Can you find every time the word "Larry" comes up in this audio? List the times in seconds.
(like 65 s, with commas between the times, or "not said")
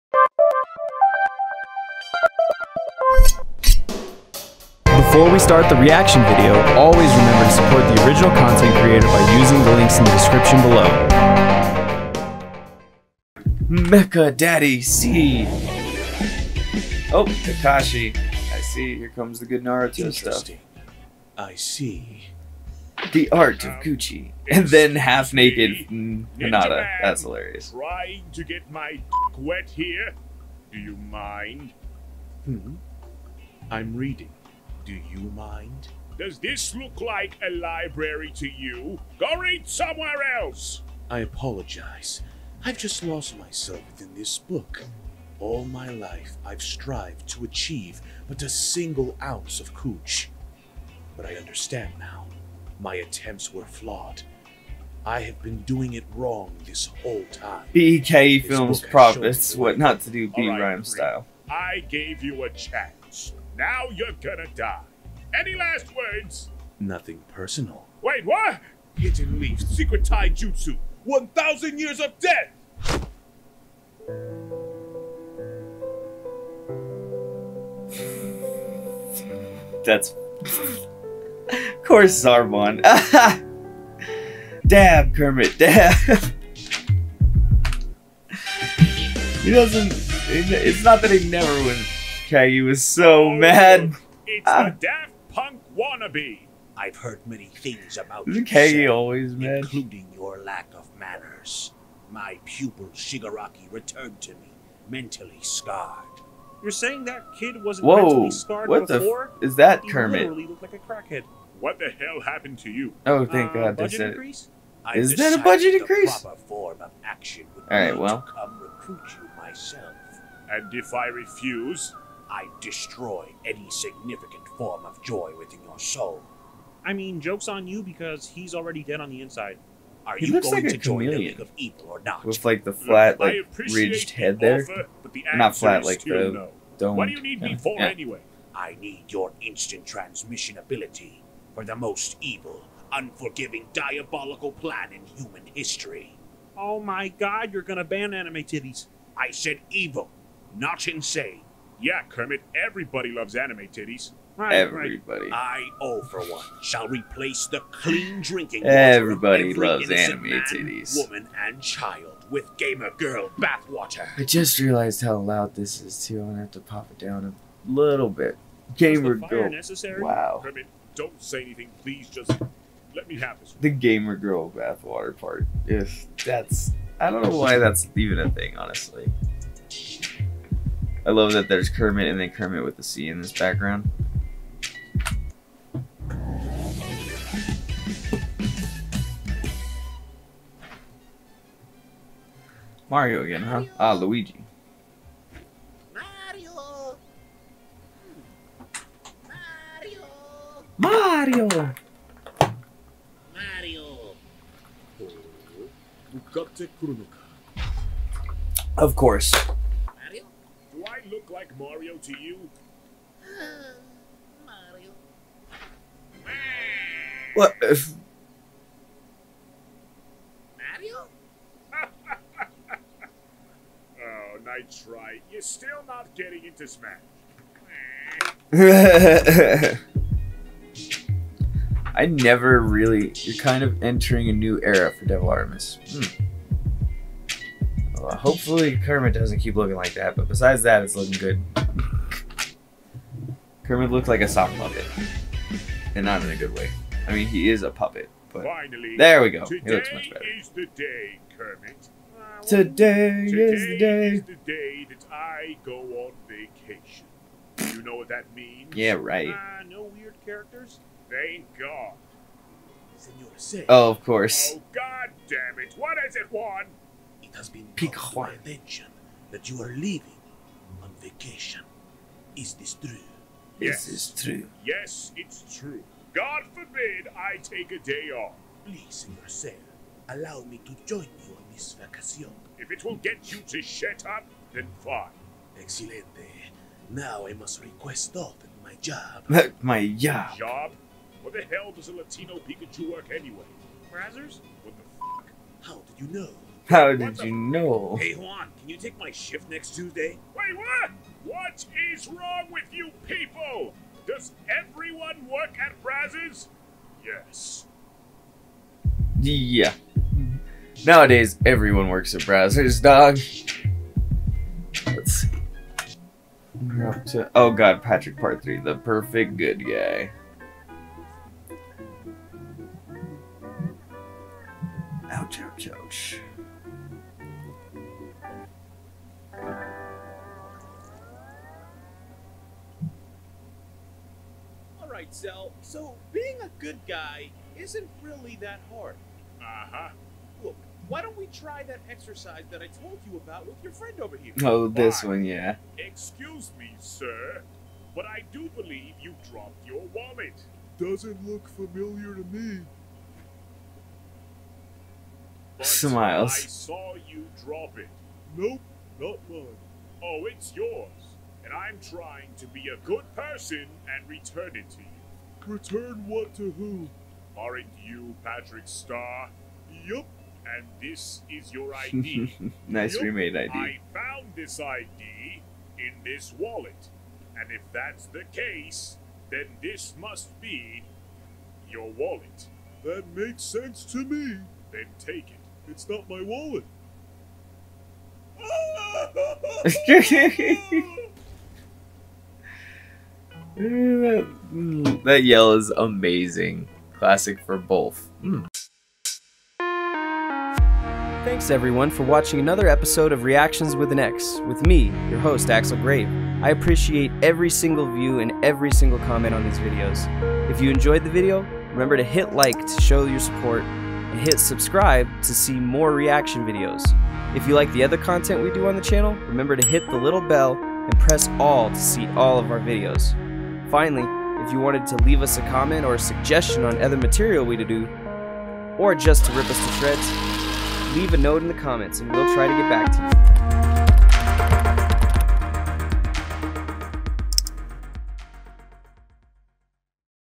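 not said.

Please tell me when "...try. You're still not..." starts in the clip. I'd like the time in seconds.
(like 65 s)
224 s.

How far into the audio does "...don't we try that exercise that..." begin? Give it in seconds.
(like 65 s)
341 s.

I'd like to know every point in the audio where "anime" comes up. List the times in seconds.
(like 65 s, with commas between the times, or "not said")
148 s, 153 s, 159 s.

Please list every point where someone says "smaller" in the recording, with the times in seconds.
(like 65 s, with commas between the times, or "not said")
not said.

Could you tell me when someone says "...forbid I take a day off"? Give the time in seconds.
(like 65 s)
276 s.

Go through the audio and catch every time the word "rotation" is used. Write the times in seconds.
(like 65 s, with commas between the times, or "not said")
not said.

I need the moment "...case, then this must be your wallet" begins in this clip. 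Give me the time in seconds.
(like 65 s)
378 s.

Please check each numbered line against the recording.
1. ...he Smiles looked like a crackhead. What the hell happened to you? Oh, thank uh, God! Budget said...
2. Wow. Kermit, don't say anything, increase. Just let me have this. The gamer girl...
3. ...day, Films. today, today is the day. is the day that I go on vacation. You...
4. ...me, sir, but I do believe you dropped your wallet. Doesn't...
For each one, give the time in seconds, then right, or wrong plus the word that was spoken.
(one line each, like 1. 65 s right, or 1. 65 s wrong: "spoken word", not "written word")
1. 109 s wrong: "Literally", not "Smiles"
2. 170 s wrong: "please", not "increase"
3. 250 s wrong: "Kermit", not "Films"
4. 346 s right.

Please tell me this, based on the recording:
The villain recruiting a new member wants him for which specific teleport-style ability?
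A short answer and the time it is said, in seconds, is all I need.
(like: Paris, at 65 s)
Instant transmission, at 139 s.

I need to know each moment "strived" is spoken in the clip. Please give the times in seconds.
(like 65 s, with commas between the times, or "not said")
46 s.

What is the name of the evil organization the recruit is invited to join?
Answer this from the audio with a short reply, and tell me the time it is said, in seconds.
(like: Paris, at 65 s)
League of Evil, at 131 s.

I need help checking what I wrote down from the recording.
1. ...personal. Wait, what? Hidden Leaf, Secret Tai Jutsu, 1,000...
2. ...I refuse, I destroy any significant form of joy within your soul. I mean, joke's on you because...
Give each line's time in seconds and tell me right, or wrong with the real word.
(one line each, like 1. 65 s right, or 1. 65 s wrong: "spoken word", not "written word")
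1. 67 s right
2. 120 s right.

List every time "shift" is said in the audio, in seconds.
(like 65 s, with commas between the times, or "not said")
299 s.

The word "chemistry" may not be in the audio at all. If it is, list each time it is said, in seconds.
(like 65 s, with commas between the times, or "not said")
not said.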